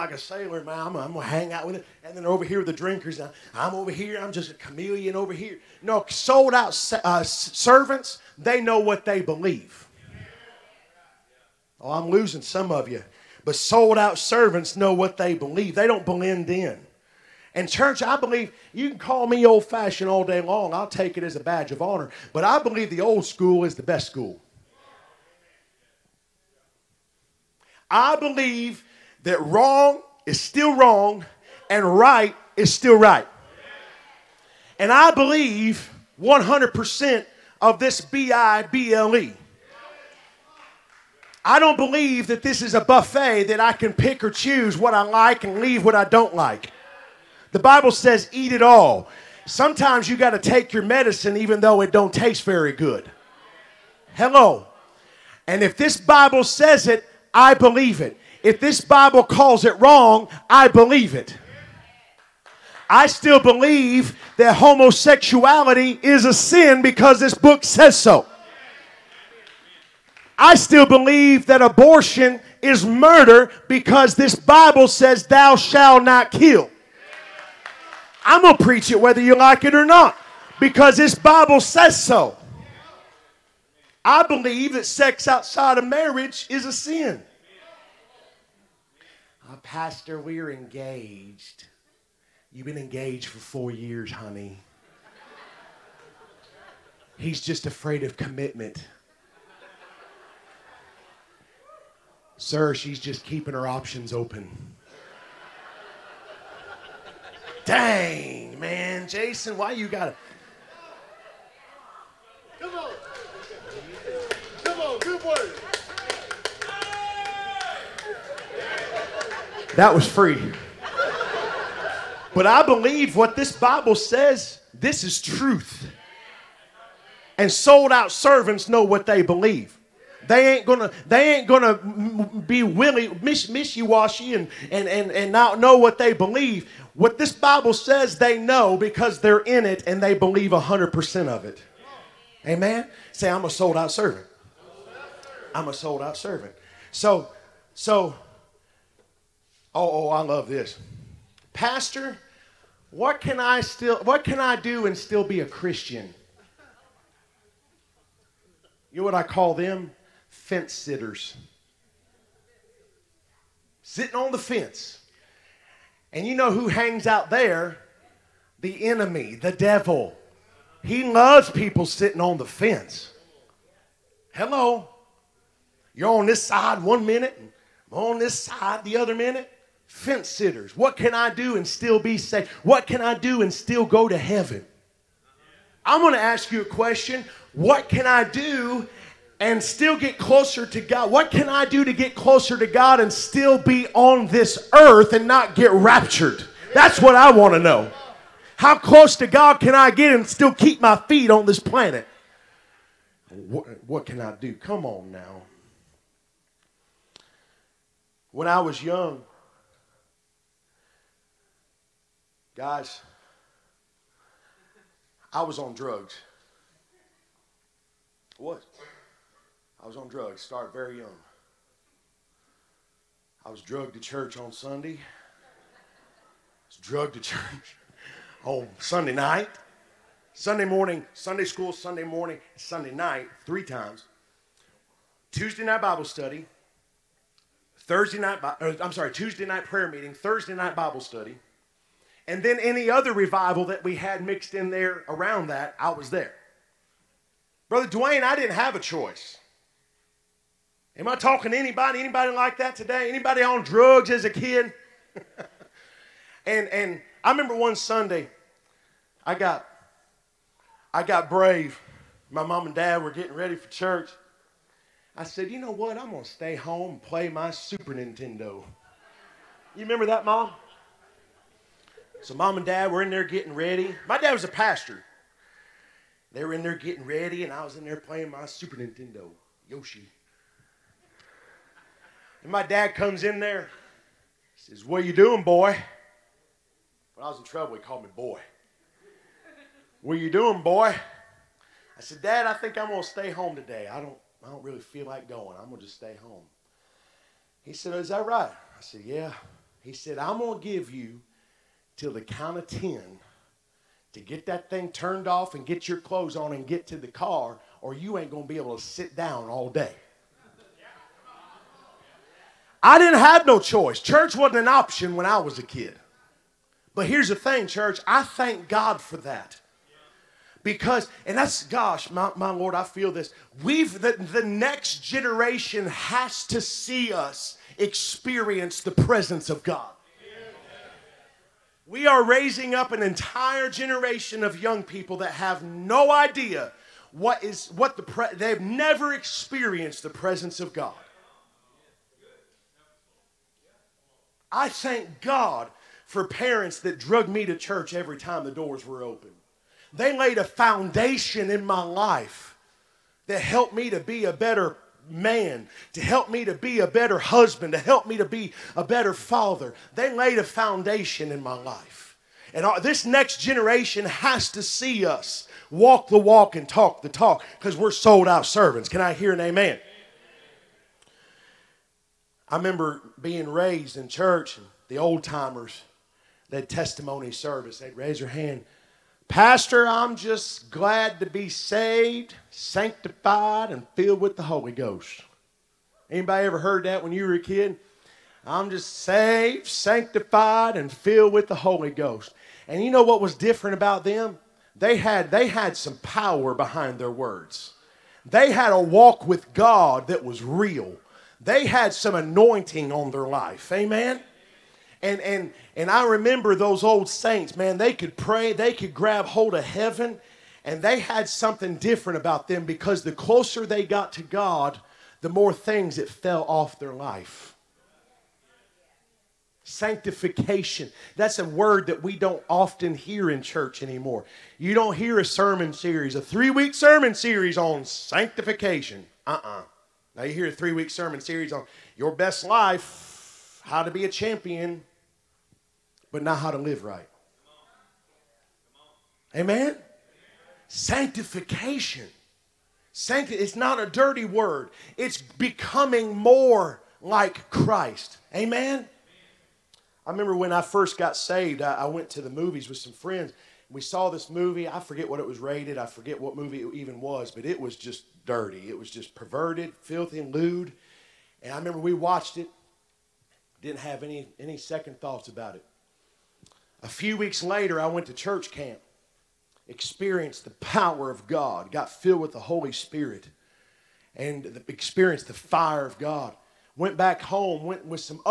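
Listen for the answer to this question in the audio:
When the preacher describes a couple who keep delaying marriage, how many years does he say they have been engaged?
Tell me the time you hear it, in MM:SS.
01:33.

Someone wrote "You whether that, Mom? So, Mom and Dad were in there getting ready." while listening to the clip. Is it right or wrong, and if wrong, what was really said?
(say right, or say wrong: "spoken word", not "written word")
wrong: "remember", not "whether".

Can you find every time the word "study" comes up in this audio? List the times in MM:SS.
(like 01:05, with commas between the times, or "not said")
03:56, 04:01.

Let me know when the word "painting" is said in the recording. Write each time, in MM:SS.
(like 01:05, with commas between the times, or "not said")
not said.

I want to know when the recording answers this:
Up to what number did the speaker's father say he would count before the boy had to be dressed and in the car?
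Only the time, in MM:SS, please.
05:02.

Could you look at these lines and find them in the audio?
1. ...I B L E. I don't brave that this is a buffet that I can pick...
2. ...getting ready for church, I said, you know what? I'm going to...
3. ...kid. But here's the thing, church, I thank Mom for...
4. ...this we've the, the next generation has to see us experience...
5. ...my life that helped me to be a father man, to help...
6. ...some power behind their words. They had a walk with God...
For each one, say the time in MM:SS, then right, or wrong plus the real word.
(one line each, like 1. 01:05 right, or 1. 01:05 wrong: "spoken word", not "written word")
1. 00:38 wrong: "believe", not "brave"
2. 04:23 right
3. 05:15 wrong: "God", not "Mom"
4. 05:23 right
5. 05:51 wrong: "better", not "father"
6. 06:35 right.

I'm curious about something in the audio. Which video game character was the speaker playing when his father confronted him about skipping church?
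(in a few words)
Yoshi.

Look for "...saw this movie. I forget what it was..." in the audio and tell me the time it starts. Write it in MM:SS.
07:33.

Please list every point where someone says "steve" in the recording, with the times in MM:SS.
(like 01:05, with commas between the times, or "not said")
not said.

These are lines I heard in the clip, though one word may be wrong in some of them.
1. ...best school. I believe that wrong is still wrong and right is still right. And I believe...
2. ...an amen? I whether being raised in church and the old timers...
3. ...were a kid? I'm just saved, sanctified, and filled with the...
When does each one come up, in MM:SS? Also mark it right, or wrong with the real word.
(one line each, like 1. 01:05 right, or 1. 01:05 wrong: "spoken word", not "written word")
1. 00:23 right
2. 06:09 wrong: "remember", not "whether"
3. 06:27 right.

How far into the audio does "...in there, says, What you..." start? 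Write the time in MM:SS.
04:43.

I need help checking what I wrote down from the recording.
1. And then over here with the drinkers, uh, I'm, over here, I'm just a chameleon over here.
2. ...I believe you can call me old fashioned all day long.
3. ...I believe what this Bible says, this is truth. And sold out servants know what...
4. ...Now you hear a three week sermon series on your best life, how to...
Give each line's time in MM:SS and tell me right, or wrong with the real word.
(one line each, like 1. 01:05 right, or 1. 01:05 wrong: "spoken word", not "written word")
1. 00:02 right
2. 00:18 right
3. 02:02 right
4. 07:10 right.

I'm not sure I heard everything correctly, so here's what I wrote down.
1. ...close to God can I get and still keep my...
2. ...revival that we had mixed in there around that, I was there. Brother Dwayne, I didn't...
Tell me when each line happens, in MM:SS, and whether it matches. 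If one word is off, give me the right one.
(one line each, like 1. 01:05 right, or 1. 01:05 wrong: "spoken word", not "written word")
1. 03:18 right
2. 04:03 right.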